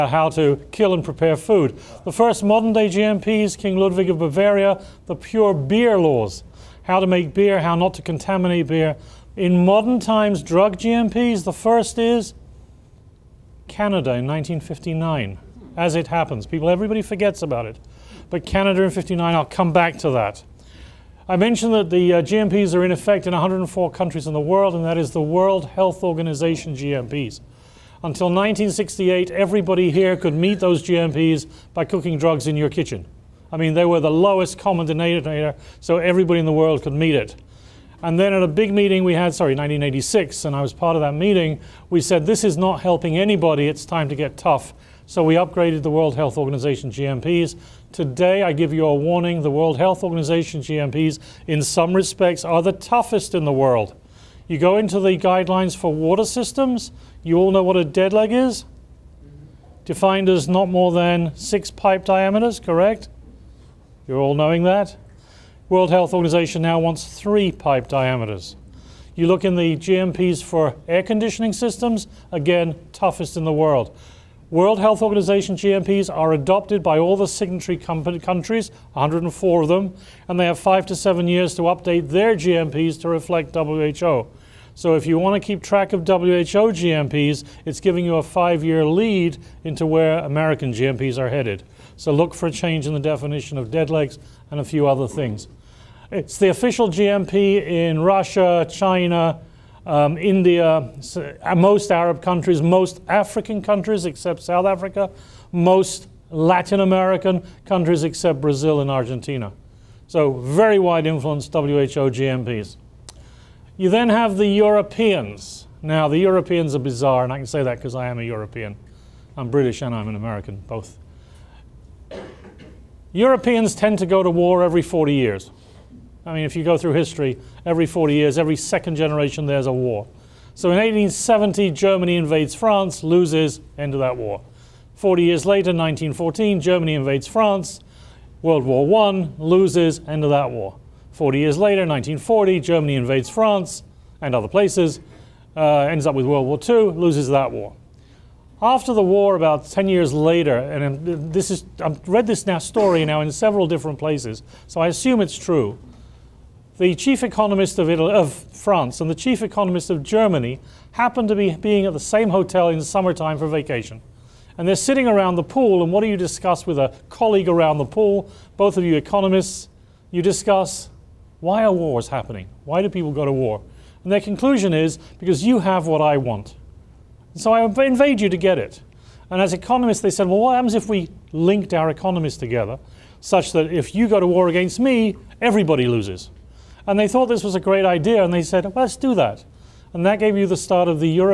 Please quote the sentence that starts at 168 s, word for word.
Both of you economists, you discuss why are wars happening?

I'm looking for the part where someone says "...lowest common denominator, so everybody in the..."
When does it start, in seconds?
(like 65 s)
34 s.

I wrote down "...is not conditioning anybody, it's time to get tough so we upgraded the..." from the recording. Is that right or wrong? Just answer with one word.
wrong.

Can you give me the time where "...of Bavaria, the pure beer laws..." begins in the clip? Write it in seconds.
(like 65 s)
4 s.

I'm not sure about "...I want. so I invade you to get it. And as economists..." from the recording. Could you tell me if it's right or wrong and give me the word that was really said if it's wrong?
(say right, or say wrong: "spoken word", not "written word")
right.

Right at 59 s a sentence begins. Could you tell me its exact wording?
Defined as not more than six pipe diameters, correct?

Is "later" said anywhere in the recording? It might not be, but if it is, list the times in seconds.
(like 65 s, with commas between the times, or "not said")
135 s, 141 s, 150 s.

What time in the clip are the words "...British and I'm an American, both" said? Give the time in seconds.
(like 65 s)
119 s.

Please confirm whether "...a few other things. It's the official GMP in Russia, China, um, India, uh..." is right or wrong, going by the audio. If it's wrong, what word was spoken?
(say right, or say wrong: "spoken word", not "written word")
right.